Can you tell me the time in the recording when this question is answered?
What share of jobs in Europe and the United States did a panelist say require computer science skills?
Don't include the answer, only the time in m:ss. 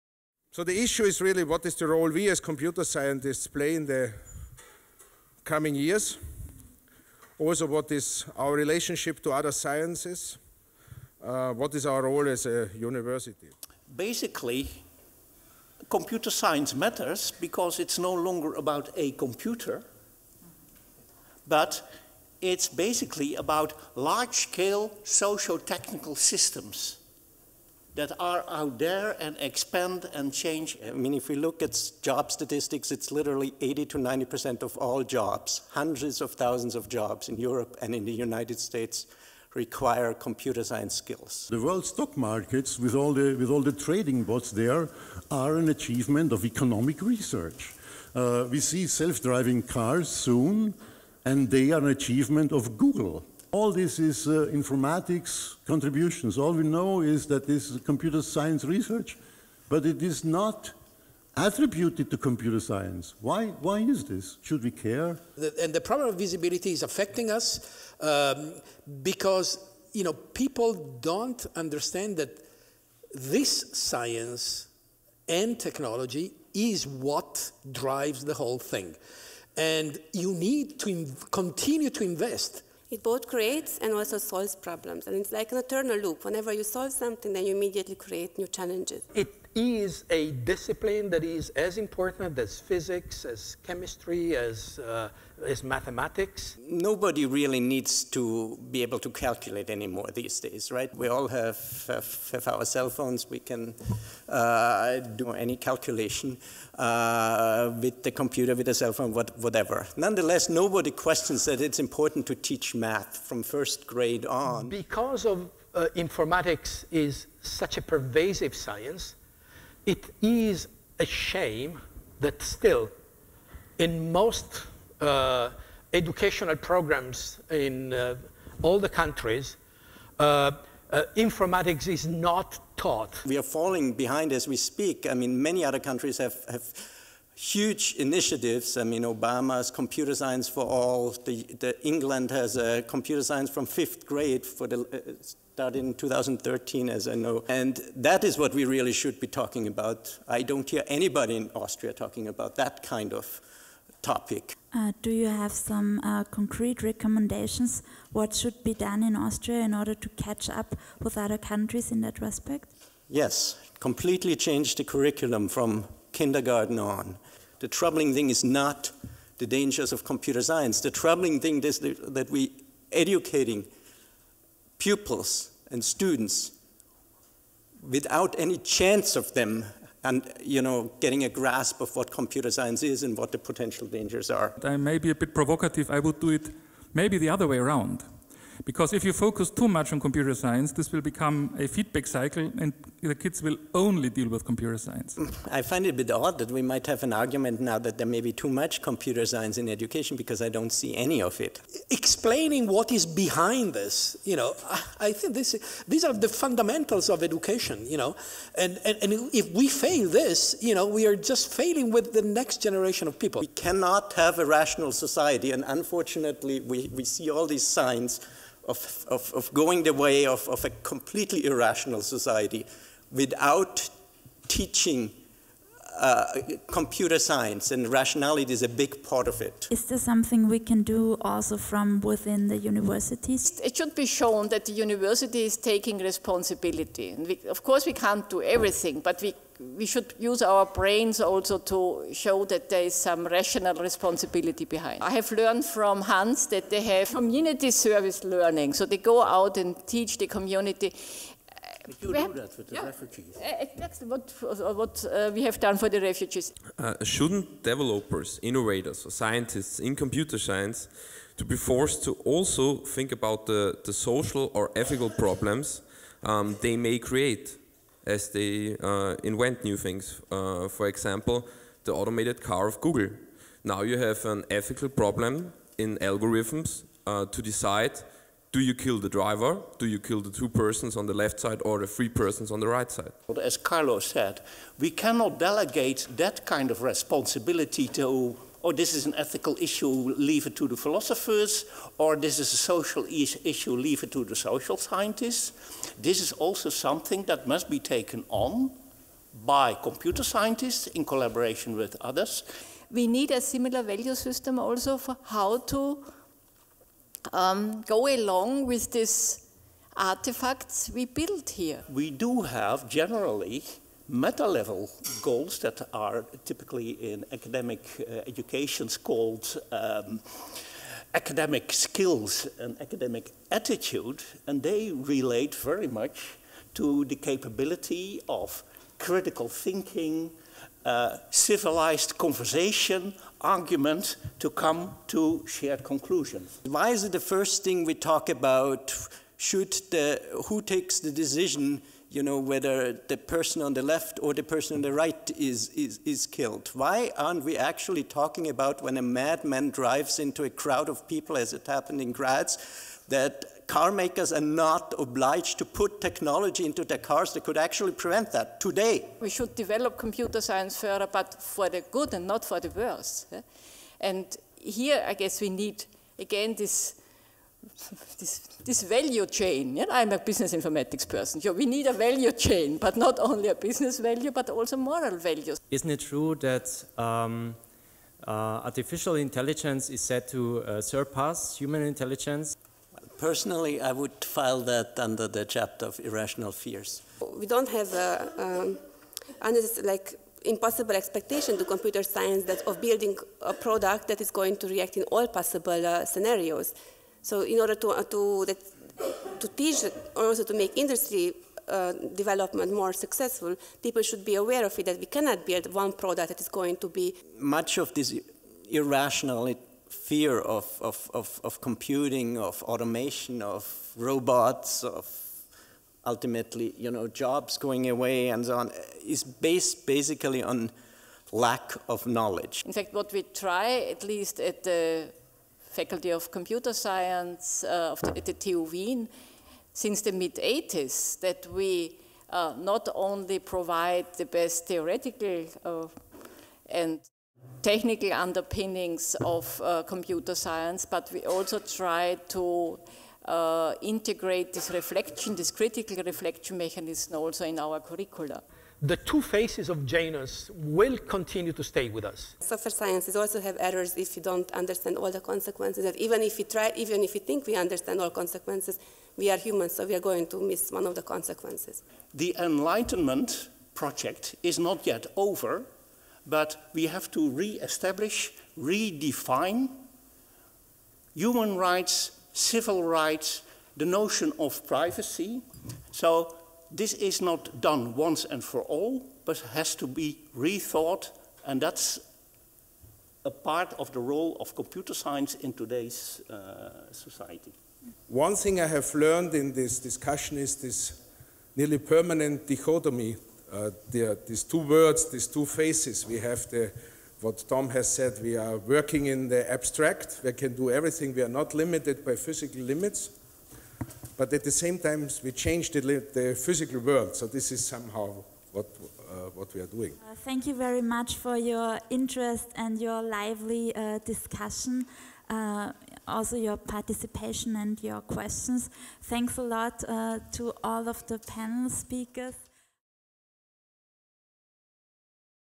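0:33.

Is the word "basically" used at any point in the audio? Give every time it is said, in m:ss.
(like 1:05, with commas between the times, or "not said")
0:13, 0:22, 6:59.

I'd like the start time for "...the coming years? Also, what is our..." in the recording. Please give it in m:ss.
0:03.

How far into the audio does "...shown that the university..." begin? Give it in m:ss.
3:54.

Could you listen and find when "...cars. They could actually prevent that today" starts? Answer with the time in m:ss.
5:57.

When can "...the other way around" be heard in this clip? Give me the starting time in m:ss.
3:07.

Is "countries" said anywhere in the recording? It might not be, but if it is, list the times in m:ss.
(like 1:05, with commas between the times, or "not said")
2:08, 2:15, 2:41.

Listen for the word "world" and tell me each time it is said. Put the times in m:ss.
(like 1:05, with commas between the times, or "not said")
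0:41, 8:26.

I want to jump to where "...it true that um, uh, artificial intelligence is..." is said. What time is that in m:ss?
6:15.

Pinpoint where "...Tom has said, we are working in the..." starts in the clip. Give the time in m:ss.
8:17.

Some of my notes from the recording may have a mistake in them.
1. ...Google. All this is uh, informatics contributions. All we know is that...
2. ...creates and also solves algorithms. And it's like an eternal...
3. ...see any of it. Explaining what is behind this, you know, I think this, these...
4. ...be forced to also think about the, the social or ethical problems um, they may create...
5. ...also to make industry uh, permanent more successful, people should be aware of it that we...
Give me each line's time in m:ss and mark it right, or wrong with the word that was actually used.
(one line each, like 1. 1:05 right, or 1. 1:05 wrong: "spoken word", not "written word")
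1. 0:52 right
2. 1:23 wrong: "problems", not "algorithms"
3. 3:20 right
4. 4:21 right
5. 6:40 wrong: "development", not "permanent".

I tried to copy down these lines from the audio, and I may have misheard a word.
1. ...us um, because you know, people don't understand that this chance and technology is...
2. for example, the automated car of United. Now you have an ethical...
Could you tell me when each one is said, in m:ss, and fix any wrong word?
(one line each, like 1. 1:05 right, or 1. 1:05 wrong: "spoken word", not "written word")
1. 1:07 wrong: "science", not "chance"
2. 4:30 wrong: "Google", not "United".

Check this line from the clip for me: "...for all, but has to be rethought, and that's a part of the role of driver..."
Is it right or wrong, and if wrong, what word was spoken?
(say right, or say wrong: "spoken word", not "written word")
wrong: "computer", not "driver".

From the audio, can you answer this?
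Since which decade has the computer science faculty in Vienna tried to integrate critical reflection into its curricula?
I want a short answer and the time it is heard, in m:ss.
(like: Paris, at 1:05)
Mid 80s, at 7:10.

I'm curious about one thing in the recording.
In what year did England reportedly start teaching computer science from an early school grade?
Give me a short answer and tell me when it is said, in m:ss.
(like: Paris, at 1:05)
2013, at 2:25.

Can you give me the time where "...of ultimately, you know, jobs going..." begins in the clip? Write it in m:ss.
6:54.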